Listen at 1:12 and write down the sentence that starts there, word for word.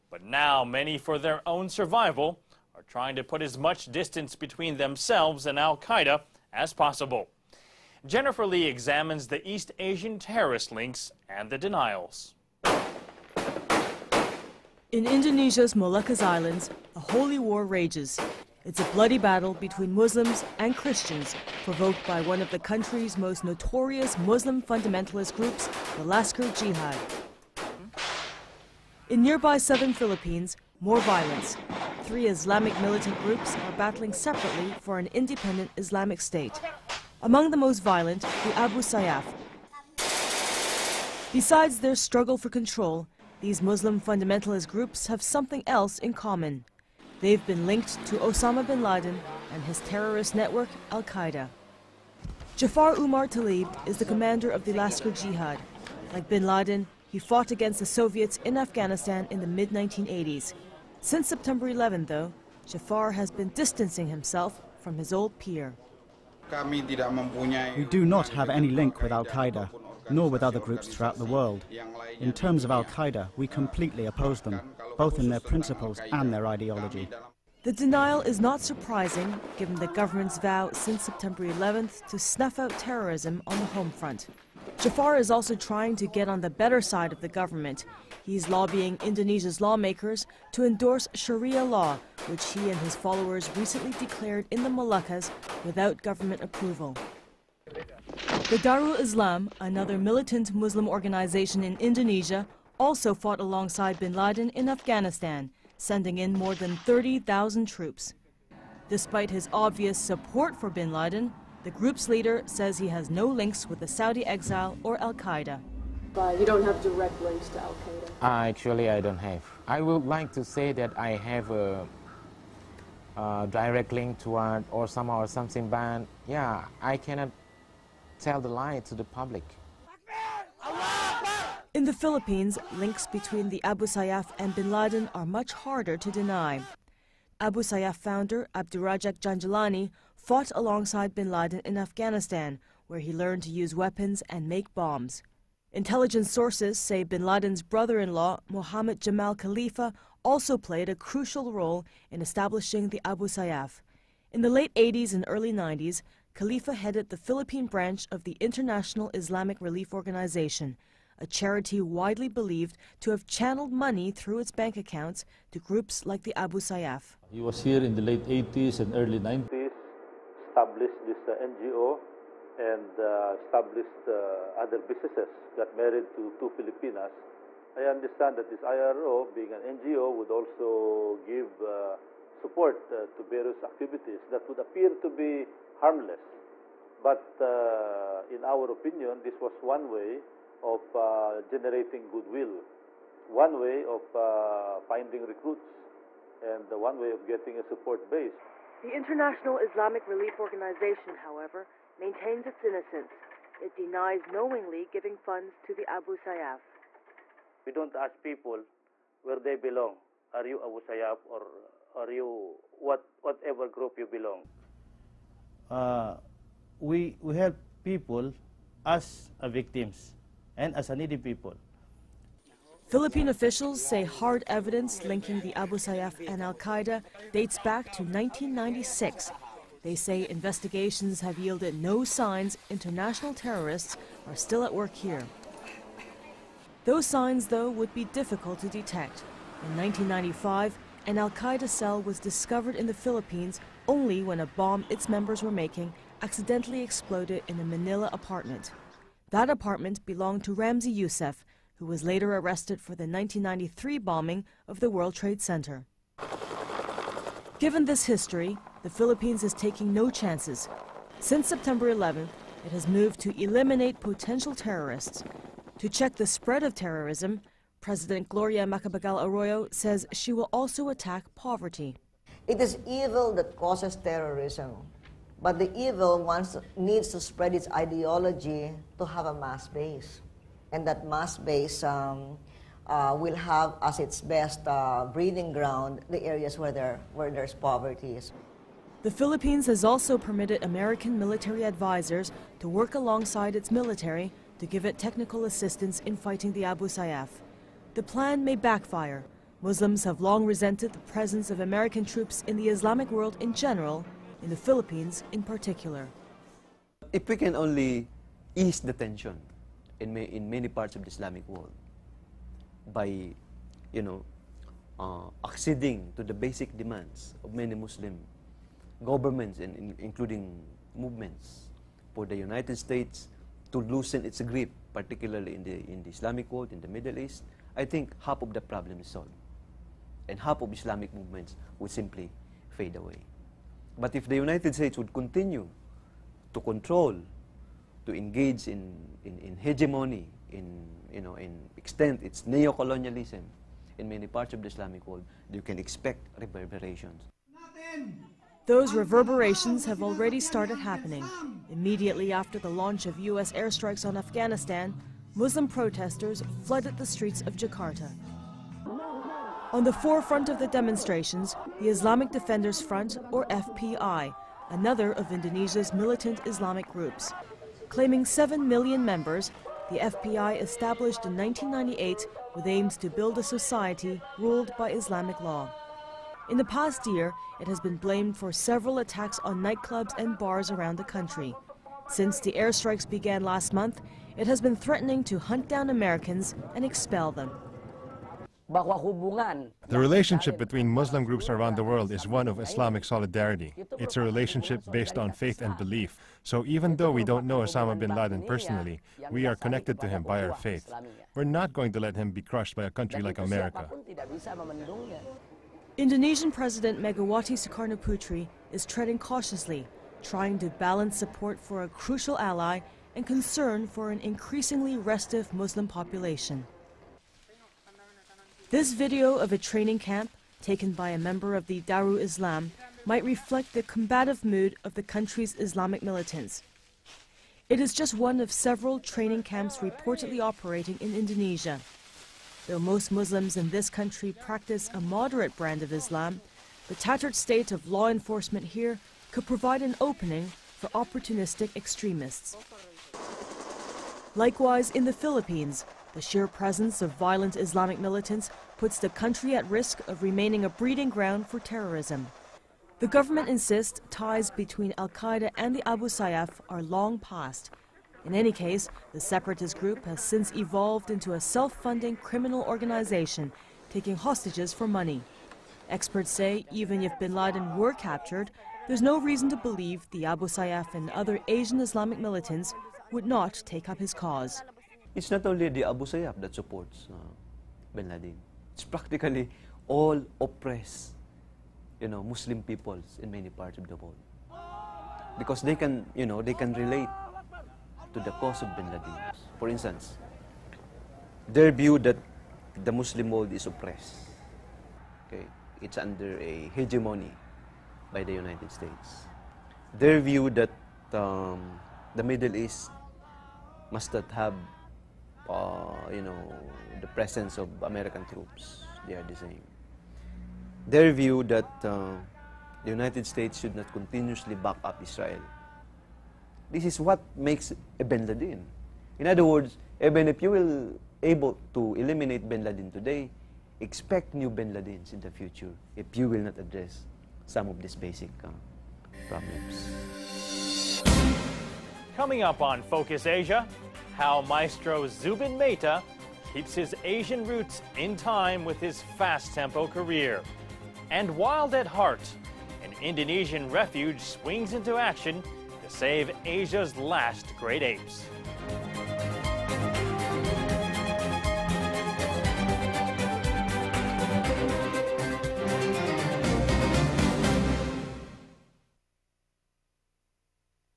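In terms of Al Qaeda, we completely oppose them, both in their principles and their ideology.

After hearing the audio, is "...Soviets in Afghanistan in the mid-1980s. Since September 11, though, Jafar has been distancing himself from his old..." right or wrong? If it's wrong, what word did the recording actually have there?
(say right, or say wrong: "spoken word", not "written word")
right.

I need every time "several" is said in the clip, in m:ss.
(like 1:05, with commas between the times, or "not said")
6:18, 7:08.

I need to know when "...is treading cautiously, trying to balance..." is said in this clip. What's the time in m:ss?
6:48.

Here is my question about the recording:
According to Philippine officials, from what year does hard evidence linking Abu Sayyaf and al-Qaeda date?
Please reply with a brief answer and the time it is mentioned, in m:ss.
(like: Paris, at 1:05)
1996, at 3:48.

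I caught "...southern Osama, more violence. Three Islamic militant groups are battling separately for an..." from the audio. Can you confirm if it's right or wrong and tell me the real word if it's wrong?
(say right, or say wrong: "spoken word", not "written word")
wrong: "Philippines", not "Osama".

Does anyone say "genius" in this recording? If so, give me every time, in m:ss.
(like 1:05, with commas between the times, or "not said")
not said.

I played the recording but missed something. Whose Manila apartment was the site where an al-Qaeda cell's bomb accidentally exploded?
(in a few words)
Ramzi Youssef.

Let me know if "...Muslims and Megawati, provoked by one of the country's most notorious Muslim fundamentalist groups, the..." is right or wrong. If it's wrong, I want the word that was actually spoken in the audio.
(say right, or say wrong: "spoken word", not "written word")
wrong: "Christians", not "Megawati".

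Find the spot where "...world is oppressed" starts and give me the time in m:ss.
8:13.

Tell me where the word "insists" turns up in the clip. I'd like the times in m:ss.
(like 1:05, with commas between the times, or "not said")
7:33.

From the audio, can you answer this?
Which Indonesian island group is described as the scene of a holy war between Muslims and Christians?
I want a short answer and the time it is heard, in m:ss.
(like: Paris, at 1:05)
Moluccas Islands, at 0:15.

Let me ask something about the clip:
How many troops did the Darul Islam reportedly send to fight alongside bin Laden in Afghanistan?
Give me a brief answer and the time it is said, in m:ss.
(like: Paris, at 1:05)
30,000, at 1:46.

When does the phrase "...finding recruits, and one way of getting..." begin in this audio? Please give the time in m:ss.
3:14.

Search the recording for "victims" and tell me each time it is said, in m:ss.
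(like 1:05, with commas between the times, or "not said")
3:39.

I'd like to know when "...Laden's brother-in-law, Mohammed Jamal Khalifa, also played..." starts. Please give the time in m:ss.
2:27.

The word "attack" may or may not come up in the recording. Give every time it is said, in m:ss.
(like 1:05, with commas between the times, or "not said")
4:30, 6:19.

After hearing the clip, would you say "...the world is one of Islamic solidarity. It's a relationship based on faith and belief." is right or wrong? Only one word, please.
right.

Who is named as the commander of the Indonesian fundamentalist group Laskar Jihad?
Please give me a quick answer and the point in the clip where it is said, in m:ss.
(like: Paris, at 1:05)
Jafar Umar Talib, at 0:52.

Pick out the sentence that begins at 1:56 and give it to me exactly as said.
But you don't have direct links to al-Qaeda?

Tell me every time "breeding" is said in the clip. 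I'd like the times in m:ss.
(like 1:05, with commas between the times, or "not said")
4:45, 7:30.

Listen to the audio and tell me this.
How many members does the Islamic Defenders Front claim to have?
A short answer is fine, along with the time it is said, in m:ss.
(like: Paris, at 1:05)
7 million, at 6:08.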